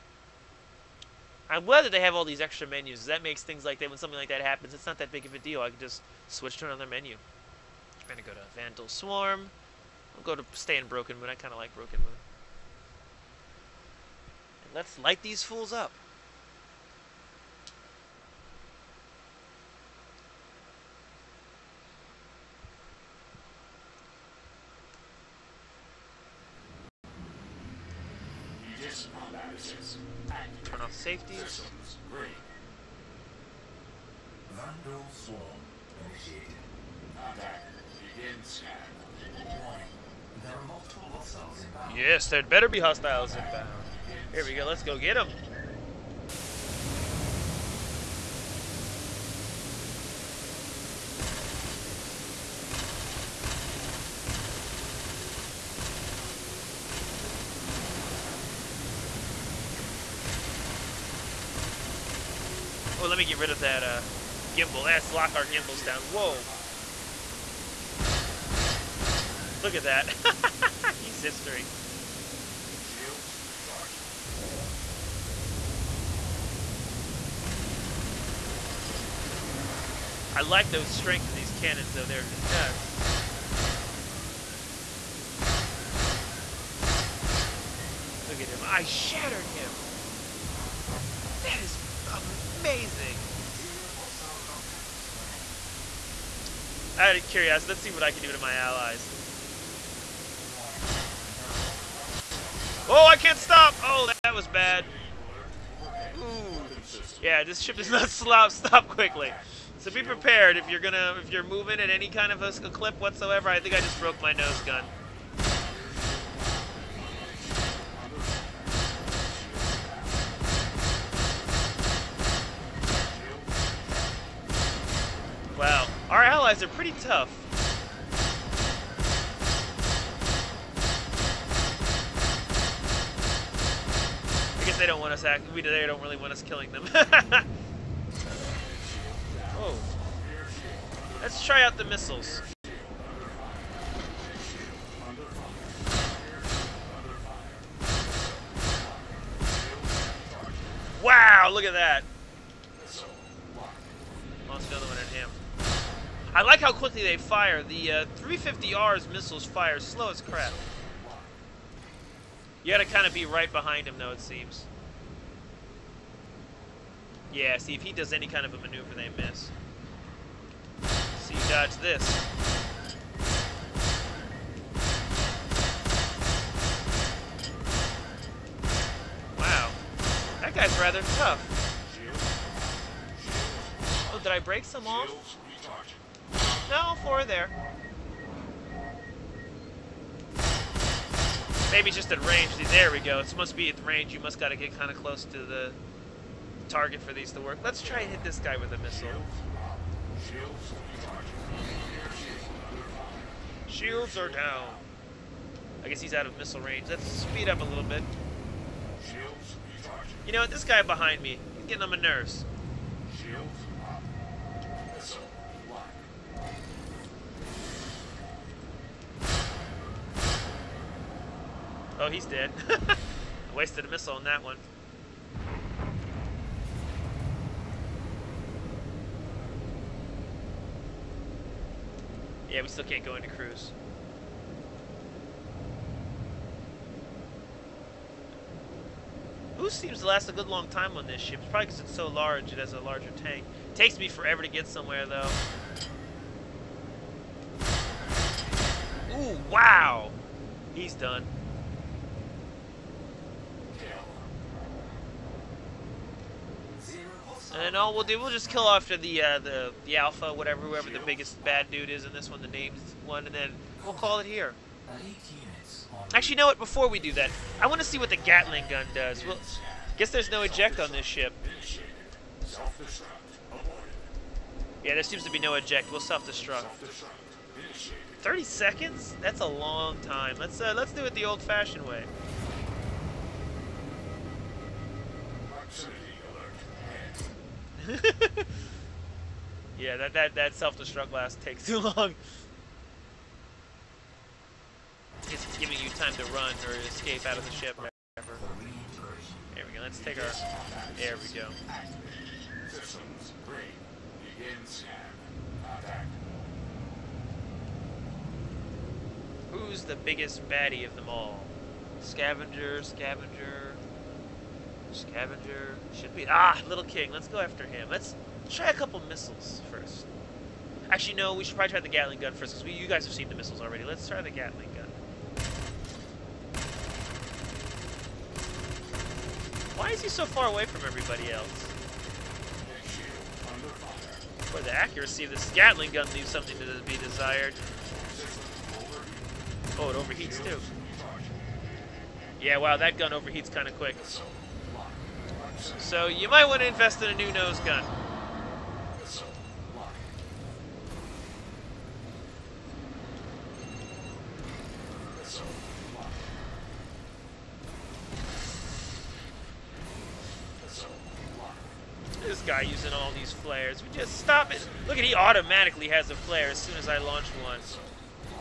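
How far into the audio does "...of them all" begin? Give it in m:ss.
5:10.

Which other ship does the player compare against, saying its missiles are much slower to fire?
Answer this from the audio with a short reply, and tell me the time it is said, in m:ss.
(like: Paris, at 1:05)
350R, at 2:38.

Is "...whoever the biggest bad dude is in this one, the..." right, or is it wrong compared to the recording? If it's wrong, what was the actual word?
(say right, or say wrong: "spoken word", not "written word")
right.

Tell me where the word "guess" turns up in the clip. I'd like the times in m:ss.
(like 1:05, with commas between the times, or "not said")
2:14, 3:25, 4:29.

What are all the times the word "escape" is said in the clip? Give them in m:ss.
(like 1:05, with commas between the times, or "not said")
4:56.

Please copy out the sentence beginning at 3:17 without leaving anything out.
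Let's try and hit this guy with a missile.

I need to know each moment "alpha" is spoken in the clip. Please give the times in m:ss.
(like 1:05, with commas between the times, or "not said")
4:19.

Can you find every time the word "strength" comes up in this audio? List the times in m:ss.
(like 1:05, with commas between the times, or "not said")
1:20.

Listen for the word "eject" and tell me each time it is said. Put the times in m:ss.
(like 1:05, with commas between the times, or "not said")
4:30, 4:35.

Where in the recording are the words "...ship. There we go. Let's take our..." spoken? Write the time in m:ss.
4:57.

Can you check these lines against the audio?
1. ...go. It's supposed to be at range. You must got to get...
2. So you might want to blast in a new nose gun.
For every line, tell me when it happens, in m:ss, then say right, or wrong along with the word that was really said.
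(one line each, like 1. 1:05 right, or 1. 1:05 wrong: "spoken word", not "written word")
1. 3:12 right
2. 5:45 wrong: "invest", not "blast".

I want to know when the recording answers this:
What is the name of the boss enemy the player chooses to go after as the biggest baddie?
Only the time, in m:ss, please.
5:16.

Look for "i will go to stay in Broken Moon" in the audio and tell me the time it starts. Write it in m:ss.
0:10.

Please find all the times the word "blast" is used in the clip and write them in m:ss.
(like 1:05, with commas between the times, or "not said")
4:51.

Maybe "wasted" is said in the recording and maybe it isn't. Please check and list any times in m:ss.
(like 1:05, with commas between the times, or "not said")
3:43.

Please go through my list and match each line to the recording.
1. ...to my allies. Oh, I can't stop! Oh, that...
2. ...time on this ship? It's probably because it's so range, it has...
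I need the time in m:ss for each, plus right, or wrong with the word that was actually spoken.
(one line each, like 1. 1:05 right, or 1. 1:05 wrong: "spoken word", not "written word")
1. 1:38 right
2. 4:00 wrong: "large", not "range".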